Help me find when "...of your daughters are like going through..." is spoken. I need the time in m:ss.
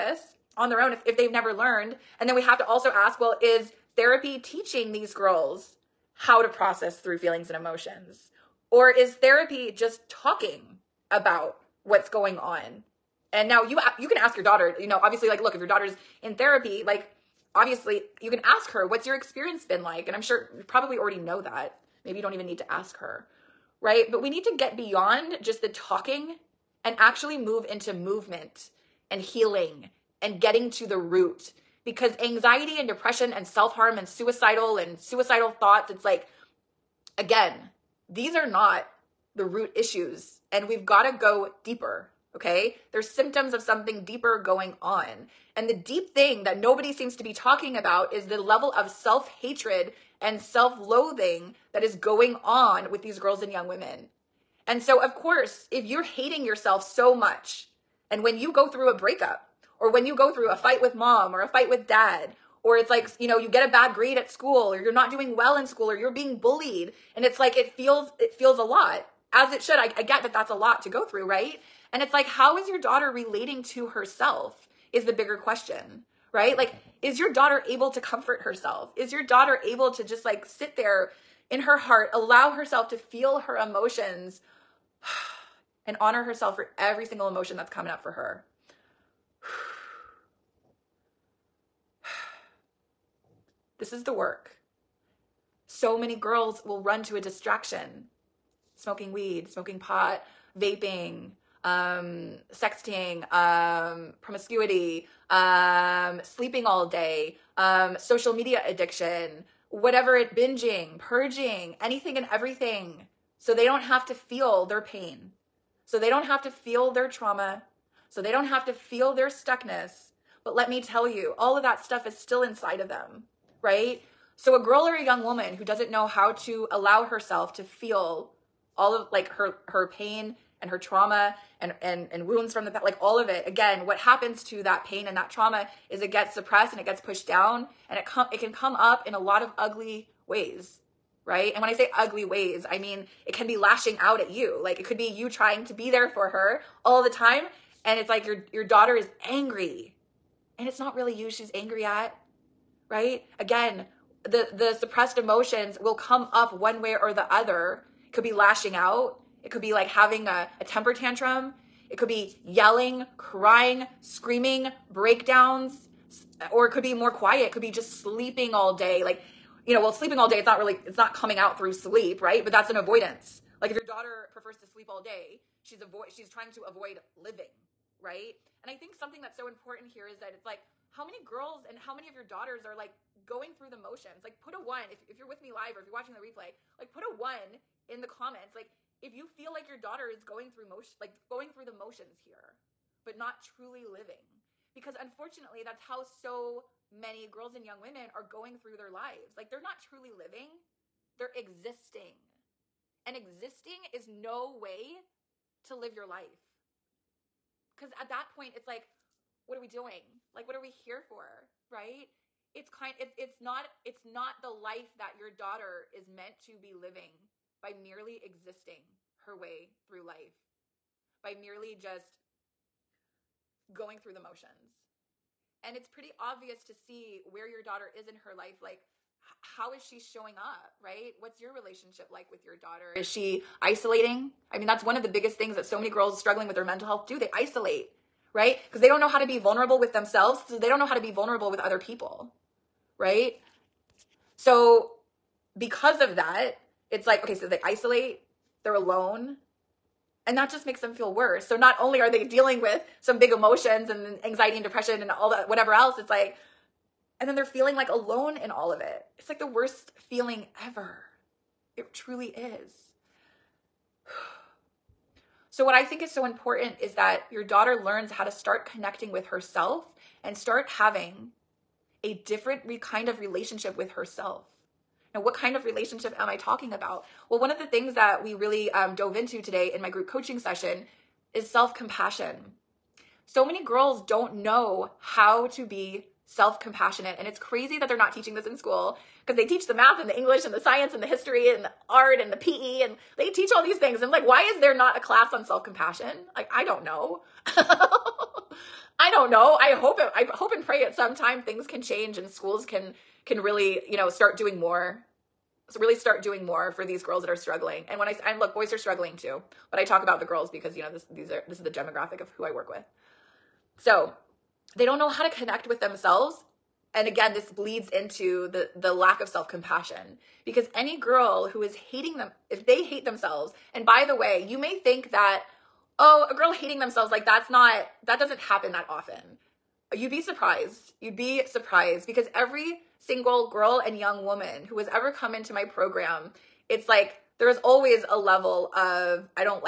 3:02.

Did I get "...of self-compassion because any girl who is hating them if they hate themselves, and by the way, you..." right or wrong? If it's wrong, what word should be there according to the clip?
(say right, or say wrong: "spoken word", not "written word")
right.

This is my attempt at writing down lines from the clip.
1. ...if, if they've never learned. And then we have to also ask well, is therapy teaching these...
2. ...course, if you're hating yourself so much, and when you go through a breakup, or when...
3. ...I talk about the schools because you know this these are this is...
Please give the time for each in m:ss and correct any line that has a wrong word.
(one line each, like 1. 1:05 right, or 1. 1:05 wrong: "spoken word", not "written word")
1. 0:00 right
2. 0:55 right
3. 5:09 wrong: "girls", not "schools".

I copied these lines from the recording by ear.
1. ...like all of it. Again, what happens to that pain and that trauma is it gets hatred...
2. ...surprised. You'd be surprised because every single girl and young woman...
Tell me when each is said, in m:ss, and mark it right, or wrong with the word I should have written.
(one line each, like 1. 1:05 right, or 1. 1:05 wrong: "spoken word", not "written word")
1. 2:12 wrong: "suppressed", not "hatred"
2. 5:30 right.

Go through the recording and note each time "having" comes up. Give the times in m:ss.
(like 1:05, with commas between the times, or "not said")
2:39, 4:30.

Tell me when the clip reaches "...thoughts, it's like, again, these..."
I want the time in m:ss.
0:35.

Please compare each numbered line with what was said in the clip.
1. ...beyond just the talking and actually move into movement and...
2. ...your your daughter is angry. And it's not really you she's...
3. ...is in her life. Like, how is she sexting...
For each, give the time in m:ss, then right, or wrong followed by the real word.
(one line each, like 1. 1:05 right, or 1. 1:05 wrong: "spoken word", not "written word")
1. 0:24 right
2. 2:28 right
3. 3:47 wrong: "showing", not "sexting".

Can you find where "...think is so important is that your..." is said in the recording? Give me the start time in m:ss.
4:25.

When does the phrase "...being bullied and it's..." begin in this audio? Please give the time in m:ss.
1:06.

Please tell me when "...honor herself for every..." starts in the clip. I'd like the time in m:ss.
1:25.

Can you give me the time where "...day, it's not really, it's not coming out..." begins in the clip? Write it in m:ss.
2:50.